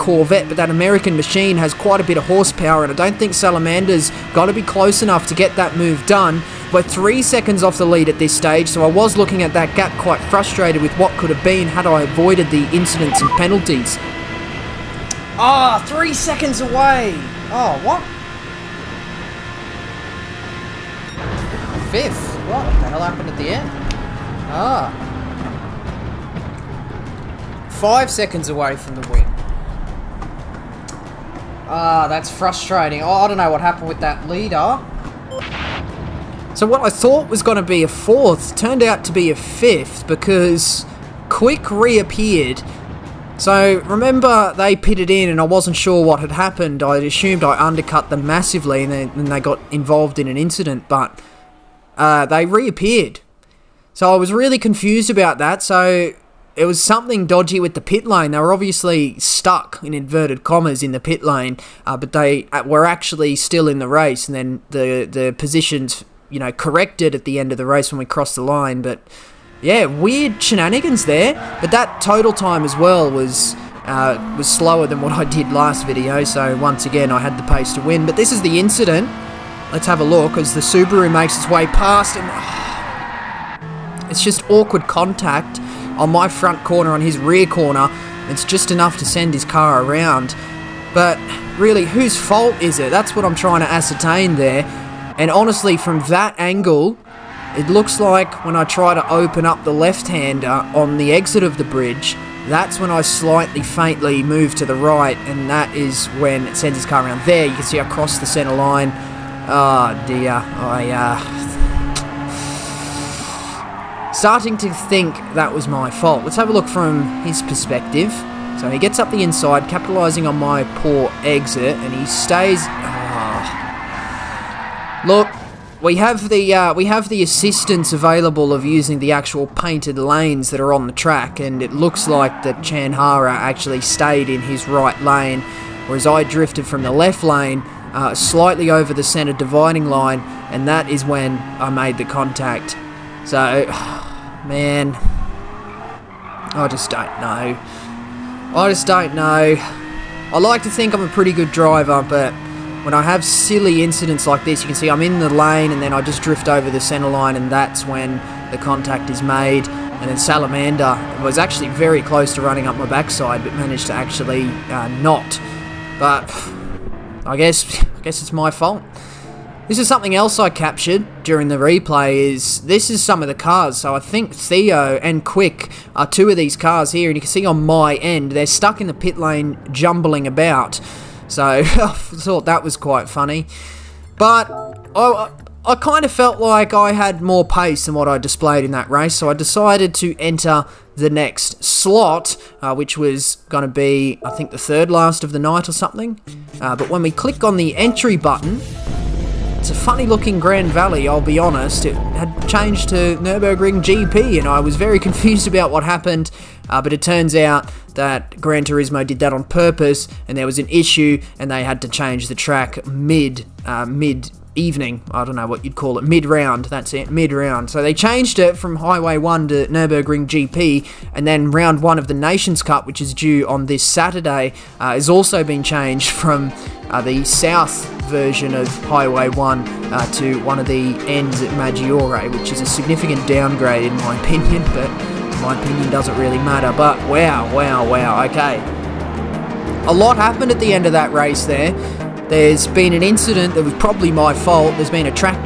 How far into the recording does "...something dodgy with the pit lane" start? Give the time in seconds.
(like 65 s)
56 s.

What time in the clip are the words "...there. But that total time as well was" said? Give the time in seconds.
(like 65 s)
71 s.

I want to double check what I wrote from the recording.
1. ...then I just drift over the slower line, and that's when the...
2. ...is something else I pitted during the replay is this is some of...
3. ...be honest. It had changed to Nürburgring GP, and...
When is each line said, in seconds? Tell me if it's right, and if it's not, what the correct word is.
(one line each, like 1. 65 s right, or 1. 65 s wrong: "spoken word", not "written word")
1. 155 s wrong: "center", not "slower"
2. 169 s wrong: "captured", not "pitted"
3. 201 s right.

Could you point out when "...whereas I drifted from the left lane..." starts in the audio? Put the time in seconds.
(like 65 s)
135 s.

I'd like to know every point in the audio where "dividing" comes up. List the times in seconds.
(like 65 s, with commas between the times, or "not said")
139 s.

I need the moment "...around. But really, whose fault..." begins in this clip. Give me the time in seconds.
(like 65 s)
89 s.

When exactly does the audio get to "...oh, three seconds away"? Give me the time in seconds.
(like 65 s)
15 s.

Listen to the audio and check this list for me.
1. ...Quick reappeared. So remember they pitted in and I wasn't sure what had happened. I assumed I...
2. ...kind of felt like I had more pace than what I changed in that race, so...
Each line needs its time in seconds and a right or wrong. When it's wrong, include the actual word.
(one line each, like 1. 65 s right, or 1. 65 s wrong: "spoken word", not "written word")
1. 41 s right
2. 185 s wrong: "displayed", not "changed".